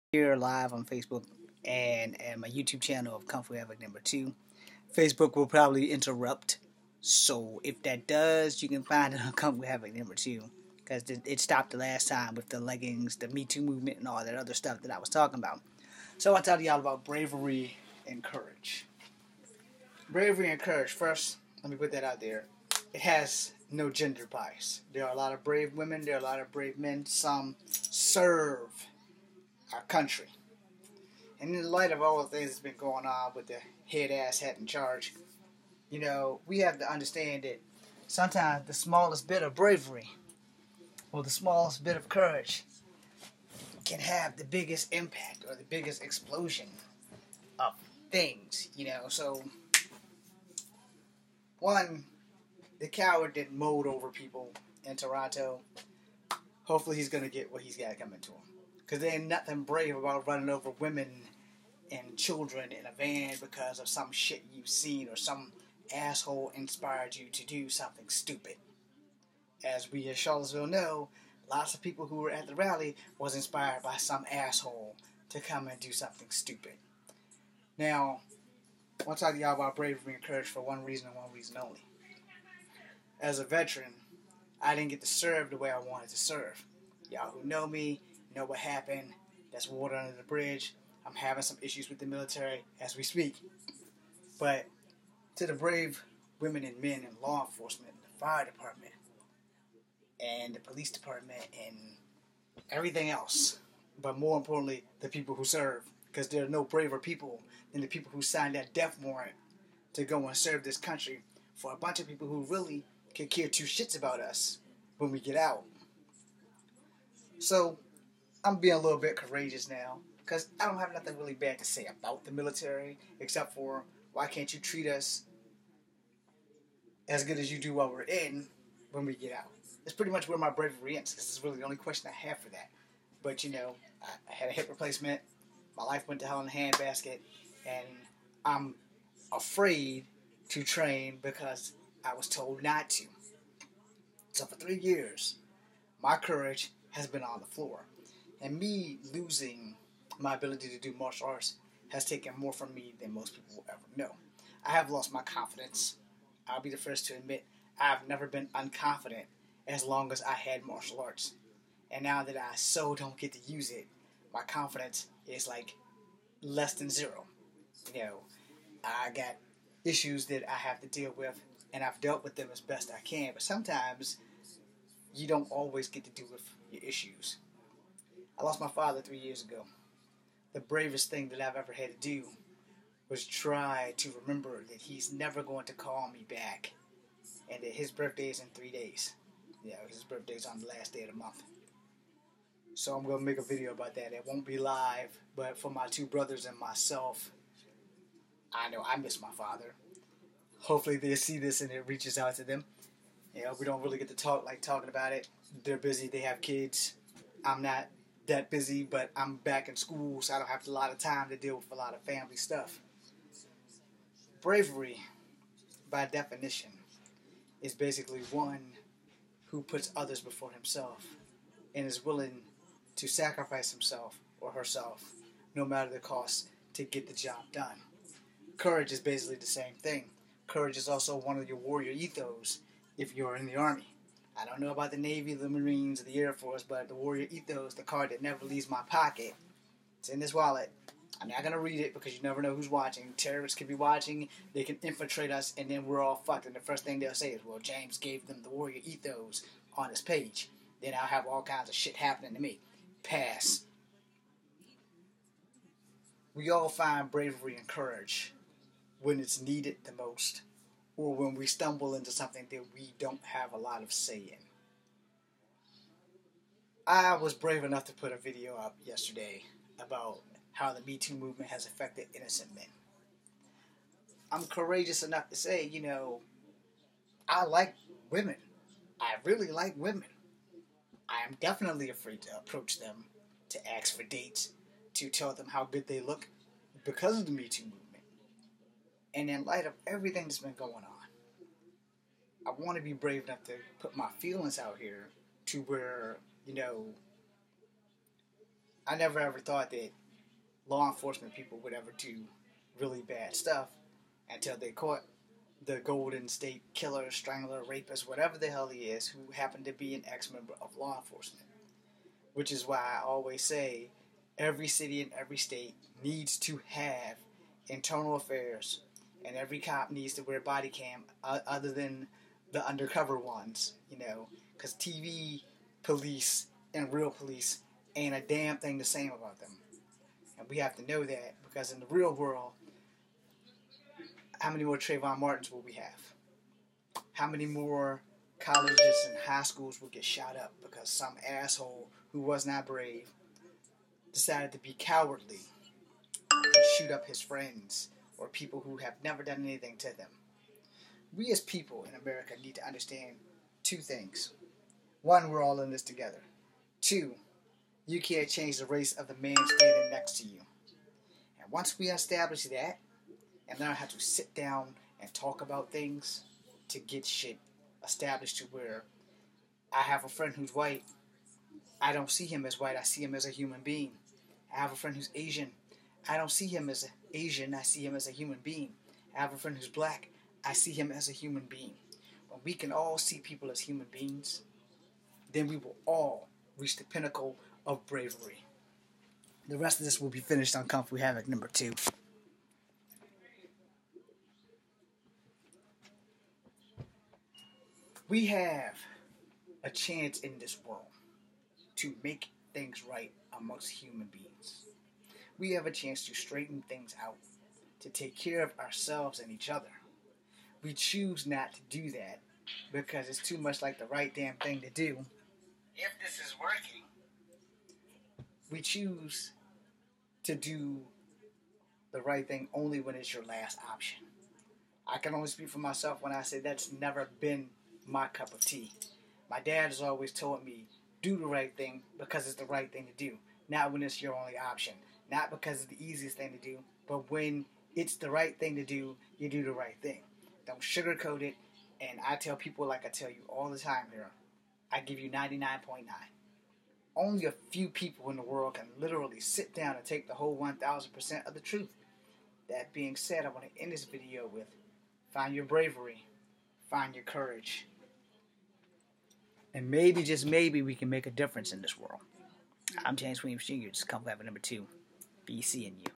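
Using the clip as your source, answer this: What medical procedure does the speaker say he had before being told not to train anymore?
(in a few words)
hip replacement.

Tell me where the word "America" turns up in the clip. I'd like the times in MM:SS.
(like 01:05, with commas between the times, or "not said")
05:51.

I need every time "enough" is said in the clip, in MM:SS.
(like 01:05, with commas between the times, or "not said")
04:27, 04:35, 04:53.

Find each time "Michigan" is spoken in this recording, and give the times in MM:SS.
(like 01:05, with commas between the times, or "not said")
not said.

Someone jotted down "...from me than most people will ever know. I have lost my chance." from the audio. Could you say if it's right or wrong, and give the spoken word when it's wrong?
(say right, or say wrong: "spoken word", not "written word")
wrong: "confidence", not "chance".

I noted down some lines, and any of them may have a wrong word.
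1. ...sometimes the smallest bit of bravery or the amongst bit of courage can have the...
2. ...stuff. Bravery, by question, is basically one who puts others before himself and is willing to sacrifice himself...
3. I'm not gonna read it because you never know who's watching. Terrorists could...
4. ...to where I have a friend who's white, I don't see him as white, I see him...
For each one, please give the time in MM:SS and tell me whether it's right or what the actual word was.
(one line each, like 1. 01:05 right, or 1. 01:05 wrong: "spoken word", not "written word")
1. 00:38 wrong: "smallest", not "amongst"
2. 03:32 wrong: "definition", not "question"
3. 04:01 right
4. 06:08 right.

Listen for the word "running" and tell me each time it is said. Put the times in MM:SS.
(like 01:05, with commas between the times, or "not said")
01:00.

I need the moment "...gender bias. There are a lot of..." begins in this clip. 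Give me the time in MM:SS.
00:23.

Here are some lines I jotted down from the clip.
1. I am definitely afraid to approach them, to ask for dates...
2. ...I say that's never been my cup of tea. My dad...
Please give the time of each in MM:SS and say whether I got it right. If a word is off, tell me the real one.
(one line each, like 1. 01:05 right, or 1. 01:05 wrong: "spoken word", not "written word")
1. 04:41 right
2. 07:06 right.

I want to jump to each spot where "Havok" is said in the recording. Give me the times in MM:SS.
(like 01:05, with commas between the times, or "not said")
00:03, 00:09, 06:30.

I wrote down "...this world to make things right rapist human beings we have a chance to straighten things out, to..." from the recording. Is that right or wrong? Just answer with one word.
wrong.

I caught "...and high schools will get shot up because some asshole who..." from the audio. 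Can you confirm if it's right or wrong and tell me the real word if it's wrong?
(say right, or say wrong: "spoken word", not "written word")
right.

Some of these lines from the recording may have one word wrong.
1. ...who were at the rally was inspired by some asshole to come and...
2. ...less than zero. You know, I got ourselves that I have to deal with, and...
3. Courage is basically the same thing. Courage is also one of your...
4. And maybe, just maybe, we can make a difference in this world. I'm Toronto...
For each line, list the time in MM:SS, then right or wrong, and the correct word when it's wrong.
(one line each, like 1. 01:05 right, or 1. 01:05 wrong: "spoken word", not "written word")
1. 01:12 right
2. 02:46 wrong: "issues", not "ourselves"
3. 03:48 right
4. 07:39 wrong: "James", not "Toronto".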